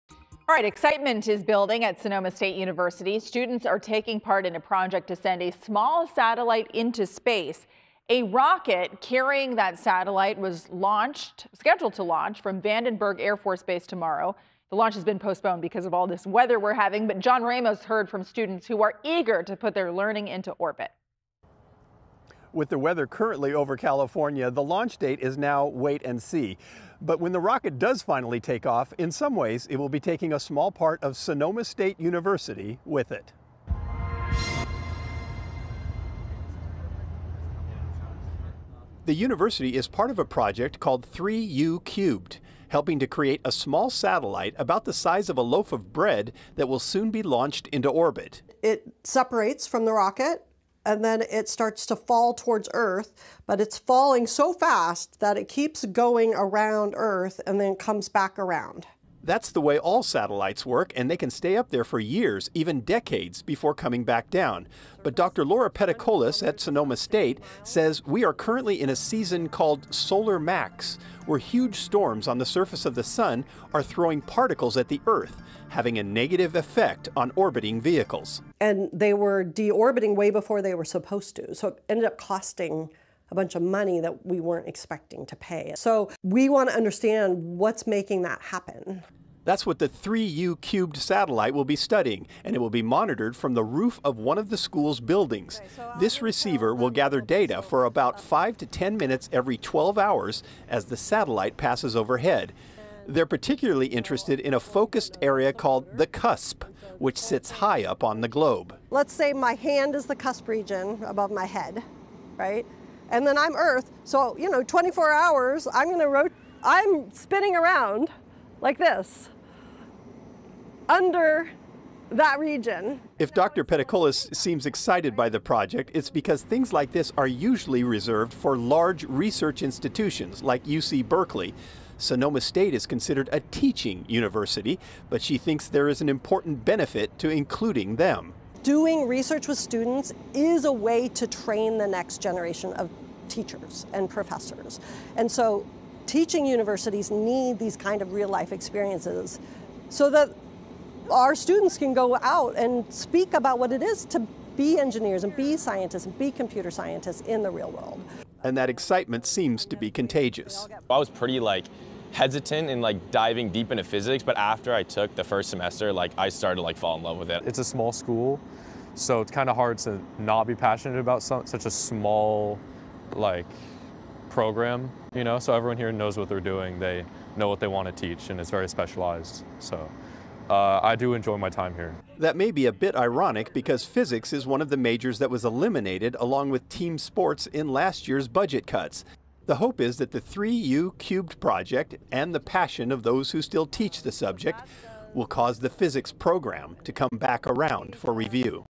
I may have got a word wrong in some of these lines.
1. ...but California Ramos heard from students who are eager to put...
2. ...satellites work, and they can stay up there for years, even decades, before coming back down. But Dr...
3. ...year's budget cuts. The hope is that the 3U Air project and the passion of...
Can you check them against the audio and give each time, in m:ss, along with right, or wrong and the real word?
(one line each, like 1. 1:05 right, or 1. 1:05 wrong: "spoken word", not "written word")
1. 0:17 wrong: "John", not "California"
2. 1:00 right
3. 3:08 wrong: "Cubed", not "Air".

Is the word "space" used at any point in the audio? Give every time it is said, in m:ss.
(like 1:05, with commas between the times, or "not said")
0:07.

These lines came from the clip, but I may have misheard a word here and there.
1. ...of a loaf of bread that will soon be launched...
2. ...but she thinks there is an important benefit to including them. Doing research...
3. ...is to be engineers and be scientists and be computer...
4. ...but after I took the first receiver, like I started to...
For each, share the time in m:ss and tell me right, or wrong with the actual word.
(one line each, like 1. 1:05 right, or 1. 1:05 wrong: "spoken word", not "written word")
1. 0:45 right
2. 2:15 right
3. 2:33 right
4. 2:44 wrong: "semester", not "receiver".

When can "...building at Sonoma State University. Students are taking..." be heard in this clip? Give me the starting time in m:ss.
0:01.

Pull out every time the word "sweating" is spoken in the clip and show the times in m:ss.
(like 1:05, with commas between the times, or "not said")
not said.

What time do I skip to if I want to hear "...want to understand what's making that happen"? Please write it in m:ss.
1:26.